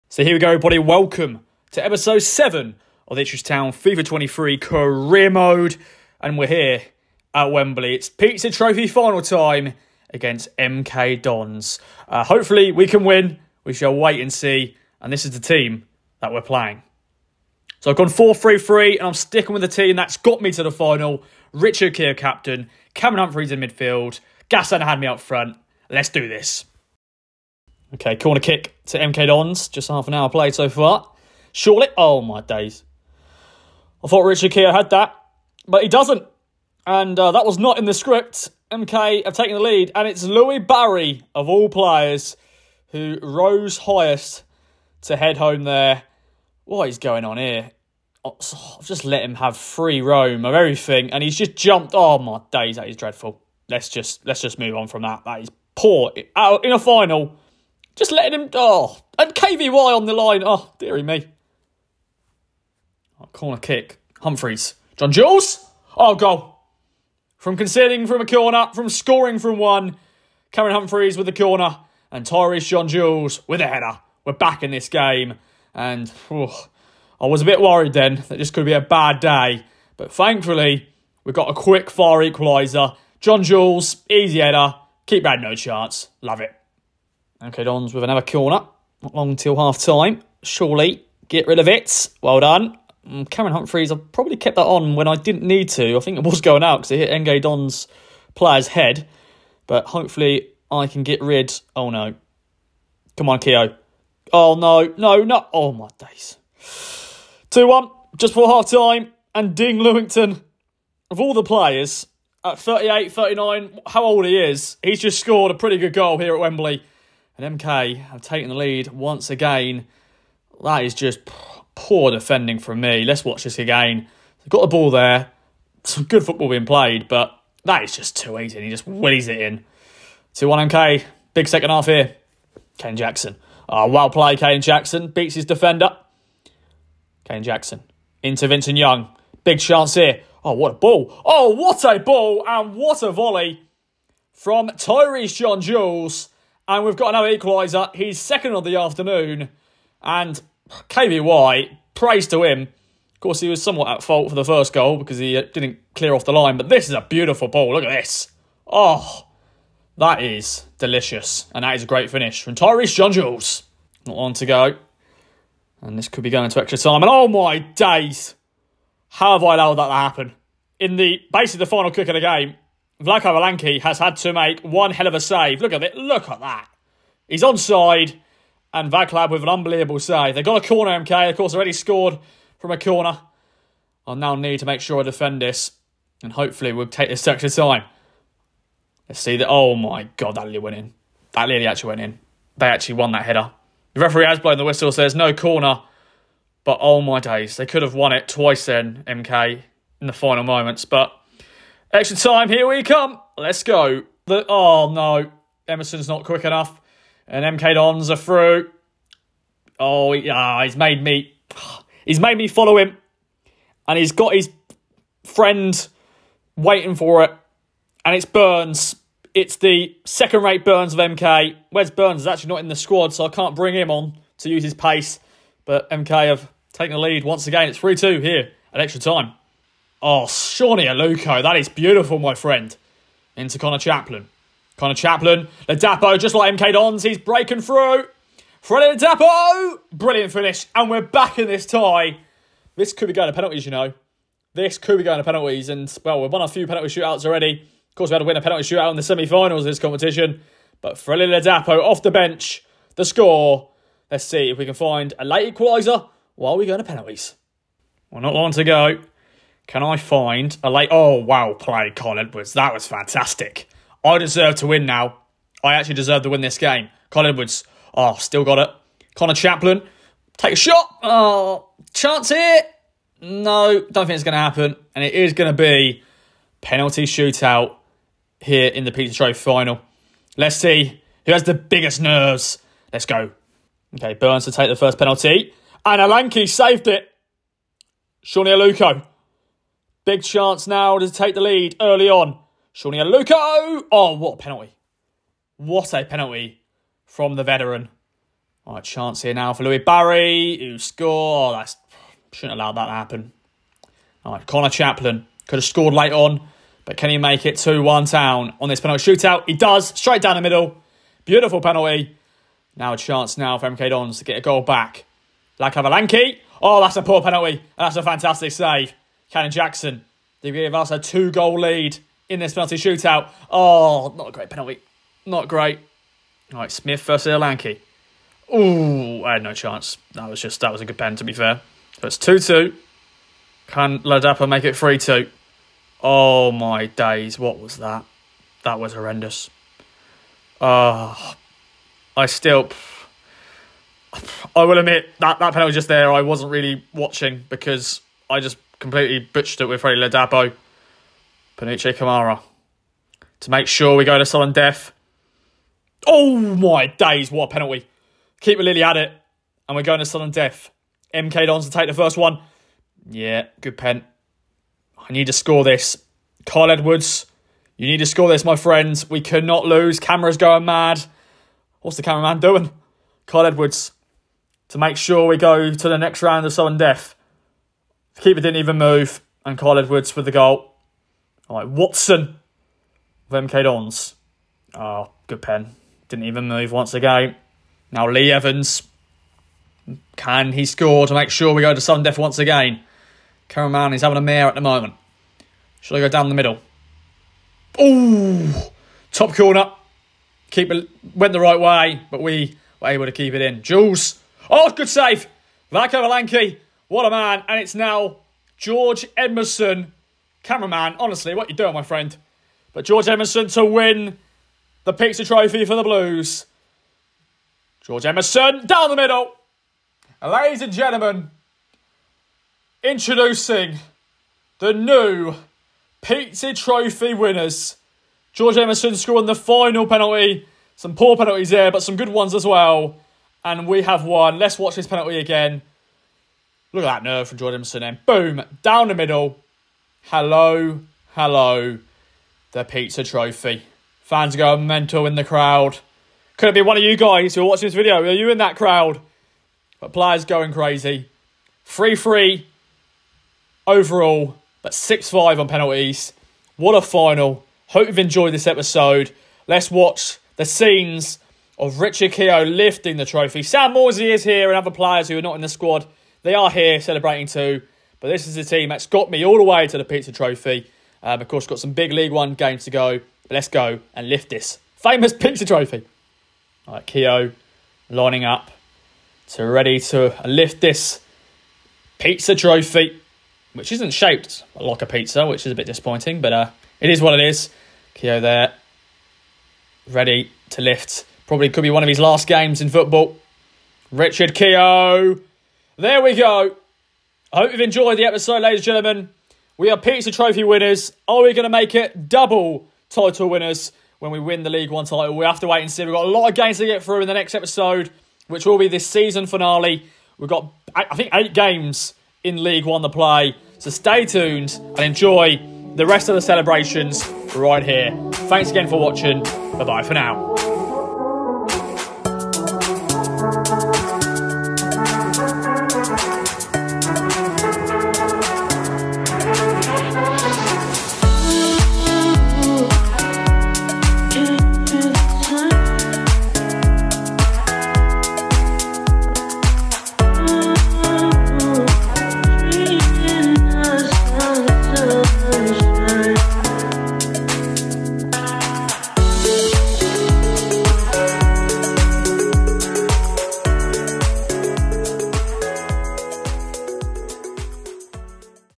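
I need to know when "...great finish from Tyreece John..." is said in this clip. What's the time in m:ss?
2:41.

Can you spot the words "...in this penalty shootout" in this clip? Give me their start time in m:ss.
5:22.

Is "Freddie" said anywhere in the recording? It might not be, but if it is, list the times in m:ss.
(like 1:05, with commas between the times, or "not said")
3:58, 4:10.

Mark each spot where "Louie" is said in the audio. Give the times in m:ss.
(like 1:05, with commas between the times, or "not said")
0:40, 4:59.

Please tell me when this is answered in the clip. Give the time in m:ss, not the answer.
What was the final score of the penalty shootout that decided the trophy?
7:34.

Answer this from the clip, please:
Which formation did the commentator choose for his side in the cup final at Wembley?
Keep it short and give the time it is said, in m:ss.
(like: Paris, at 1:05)
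4-3-3, at 0:18.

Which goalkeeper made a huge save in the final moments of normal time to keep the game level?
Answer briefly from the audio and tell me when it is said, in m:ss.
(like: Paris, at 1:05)
Vaclav Hladky, at 2:53.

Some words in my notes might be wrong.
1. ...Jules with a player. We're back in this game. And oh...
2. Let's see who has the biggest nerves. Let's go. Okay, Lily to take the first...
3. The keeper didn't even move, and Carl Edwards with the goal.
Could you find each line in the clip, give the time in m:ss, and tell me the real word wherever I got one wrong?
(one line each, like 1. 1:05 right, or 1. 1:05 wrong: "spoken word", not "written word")
1. 1:12 wrong: "header", not "player"
2. 4:40 wrong: "Burns", not "Lily"
3. 6:18 right.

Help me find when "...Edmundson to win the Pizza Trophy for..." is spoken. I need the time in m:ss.
6:53.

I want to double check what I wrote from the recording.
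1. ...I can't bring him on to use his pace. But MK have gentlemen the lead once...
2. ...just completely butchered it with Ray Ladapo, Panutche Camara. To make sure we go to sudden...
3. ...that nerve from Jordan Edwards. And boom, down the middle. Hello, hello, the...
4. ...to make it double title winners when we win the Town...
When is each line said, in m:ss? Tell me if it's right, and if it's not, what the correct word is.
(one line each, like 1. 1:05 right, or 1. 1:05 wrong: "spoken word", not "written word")
1. 3:43 wrong: "taken", not "gentlemen"
2. 5:48 right
3. 7:16 wrong: "Edmundson", not "Edwards"
4. 8:21 wrong: "League", not "Town".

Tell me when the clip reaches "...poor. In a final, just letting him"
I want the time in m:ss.
0:55.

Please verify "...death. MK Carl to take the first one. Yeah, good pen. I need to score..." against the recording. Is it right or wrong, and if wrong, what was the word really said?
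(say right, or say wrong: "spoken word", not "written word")
wrong: "Dons", not "Carl".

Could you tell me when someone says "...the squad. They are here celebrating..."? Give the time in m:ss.
7:45.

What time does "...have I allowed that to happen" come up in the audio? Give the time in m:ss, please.
2:49.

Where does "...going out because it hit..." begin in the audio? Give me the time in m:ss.
1:36.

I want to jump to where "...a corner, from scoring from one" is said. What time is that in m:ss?
1:08.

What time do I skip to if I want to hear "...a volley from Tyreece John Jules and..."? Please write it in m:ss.
2:23.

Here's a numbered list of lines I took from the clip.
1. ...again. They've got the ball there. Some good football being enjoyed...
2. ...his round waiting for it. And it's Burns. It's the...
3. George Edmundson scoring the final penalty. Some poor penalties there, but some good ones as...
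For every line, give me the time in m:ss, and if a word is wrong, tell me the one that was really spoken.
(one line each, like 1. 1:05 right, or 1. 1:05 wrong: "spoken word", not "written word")
1. 2:03 wrong: "played", not "enjoyed"
2. 3:34 wrong: "friend", not "round"
3. 7:08 right.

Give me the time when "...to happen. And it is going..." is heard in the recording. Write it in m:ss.
4:34.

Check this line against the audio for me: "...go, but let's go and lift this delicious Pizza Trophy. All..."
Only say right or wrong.
wrong.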